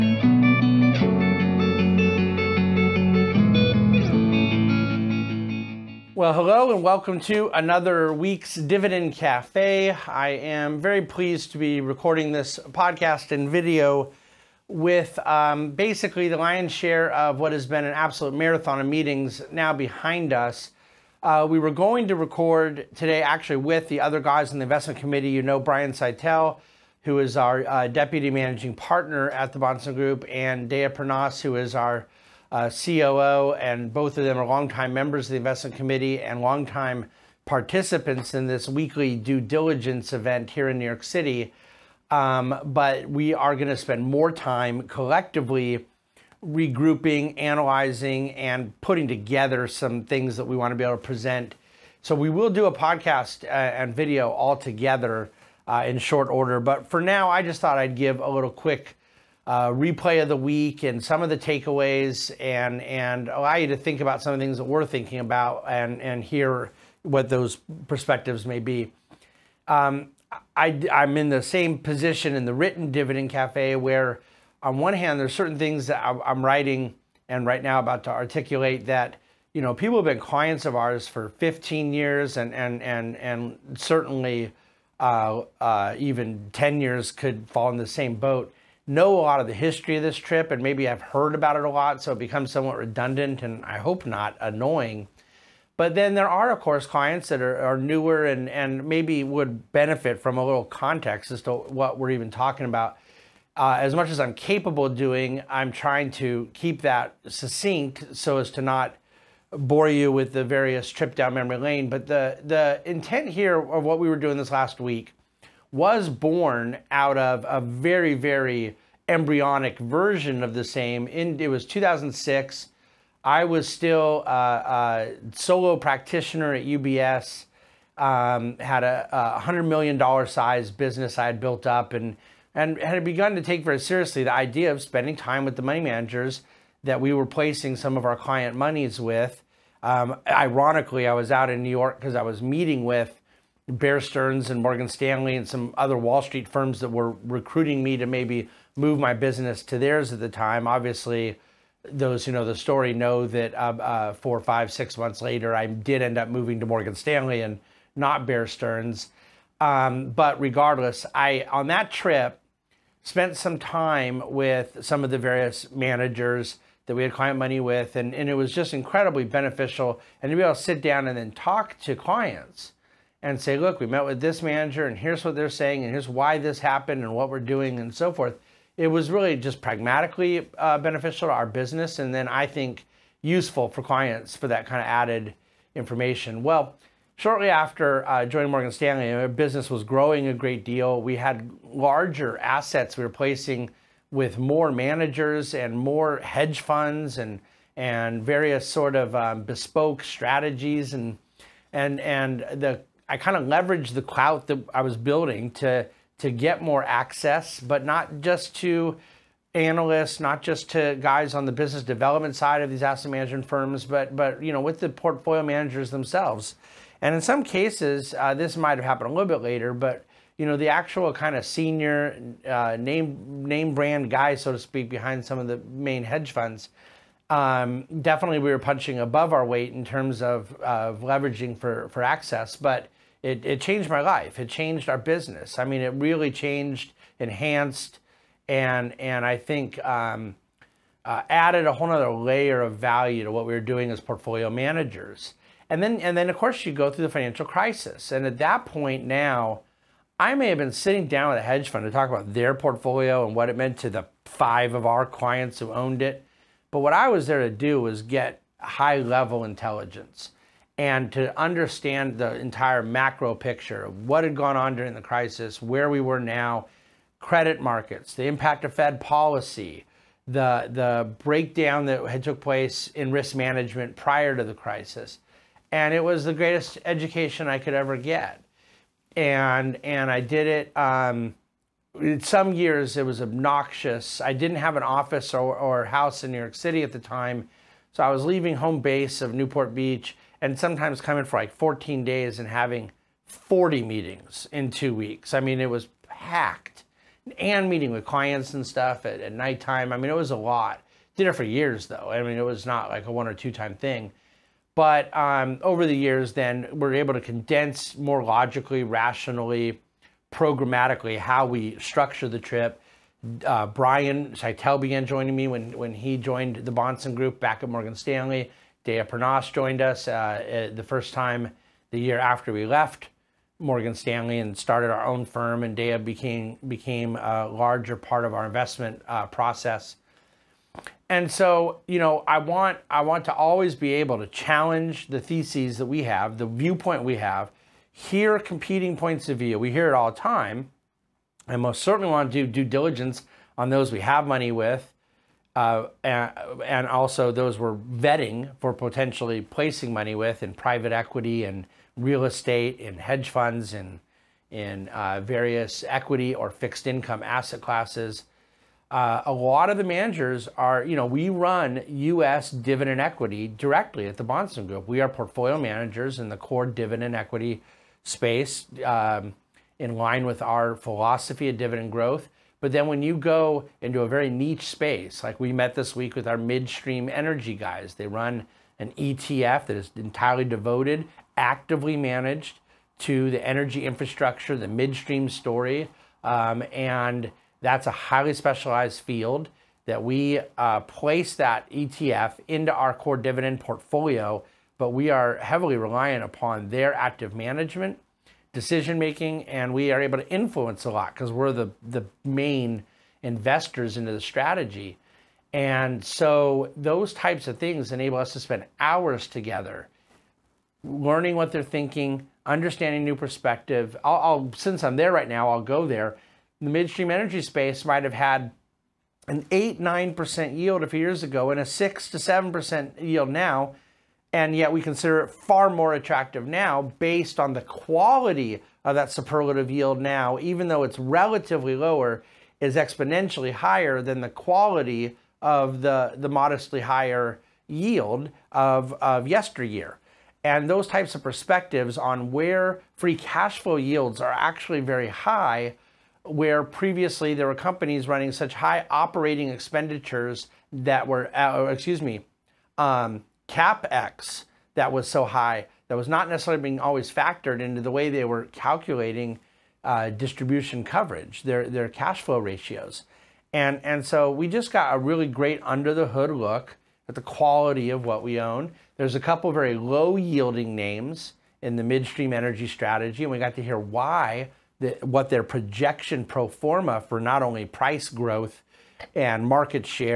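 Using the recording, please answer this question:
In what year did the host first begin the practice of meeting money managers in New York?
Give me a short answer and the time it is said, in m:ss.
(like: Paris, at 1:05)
2006, at 2:01.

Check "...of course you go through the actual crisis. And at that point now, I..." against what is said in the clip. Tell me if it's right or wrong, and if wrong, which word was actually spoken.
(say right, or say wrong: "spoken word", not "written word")
wrong: "financial", not "actual".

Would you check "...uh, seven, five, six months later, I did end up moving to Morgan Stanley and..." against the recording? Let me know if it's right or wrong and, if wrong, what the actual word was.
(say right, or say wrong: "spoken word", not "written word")
wrong: "four", not "seven".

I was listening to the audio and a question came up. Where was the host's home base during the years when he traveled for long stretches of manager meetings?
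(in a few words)
Newport Beach.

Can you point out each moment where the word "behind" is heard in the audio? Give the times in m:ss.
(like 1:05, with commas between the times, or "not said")
0:19, 3:44.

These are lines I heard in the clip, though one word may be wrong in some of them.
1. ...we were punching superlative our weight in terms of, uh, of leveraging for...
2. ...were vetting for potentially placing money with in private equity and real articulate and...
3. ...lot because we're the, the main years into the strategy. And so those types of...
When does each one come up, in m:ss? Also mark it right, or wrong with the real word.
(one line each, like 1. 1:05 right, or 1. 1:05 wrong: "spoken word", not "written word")
1. 3:48 wrong: "above", not "superlative"
2. 5:47 wrong: "estate", not "articulate"
3. 6:40 wrong: "investors", not "years".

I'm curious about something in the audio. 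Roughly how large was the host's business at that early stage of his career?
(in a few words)
$100 million.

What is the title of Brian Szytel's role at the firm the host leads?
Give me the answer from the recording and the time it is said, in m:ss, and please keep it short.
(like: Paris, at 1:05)
Deputy managing partner, at 0:27.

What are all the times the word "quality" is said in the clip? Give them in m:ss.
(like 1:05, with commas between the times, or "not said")
7:07, 7:14, 7:47.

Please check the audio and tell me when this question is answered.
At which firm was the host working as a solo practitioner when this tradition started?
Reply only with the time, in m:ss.
2:06.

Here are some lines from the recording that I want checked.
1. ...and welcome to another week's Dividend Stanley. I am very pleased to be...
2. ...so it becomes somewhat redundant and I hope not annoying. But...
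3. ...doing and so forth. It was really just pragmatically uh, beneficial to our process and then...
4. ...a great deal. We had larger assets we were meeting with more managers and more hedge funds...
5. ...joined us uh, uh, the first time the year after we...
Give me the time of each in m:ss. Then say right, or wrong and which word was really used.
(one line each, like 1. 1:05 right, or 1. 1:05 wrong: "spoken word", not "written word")
1. 0:06 wrong: "Cafe", not "Stanley"
2. 1:32 right
3. 2:57 wrong: "business", not "process"
4. 3:10 wrong: "placing", not "meeting"
5. 5:19 right.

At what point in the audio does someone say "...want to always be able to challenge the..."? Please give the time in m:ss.
5:33.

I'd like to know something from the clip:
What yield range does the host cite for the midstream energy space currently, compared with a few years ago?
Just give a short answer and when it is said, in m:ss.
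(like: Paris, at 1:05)
6 to 7 percent, at 7:01.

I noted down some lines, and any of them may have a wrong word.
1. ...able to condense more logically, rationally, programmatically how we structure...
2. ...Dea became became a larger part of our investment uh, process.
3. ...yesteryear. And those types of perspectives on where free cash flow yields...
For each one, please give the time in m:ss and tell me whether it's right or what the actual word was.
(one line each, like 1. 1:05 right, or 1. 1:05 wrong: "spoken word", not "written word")
1. 5:06 right
2. 5:25 right
3. 7:19 right.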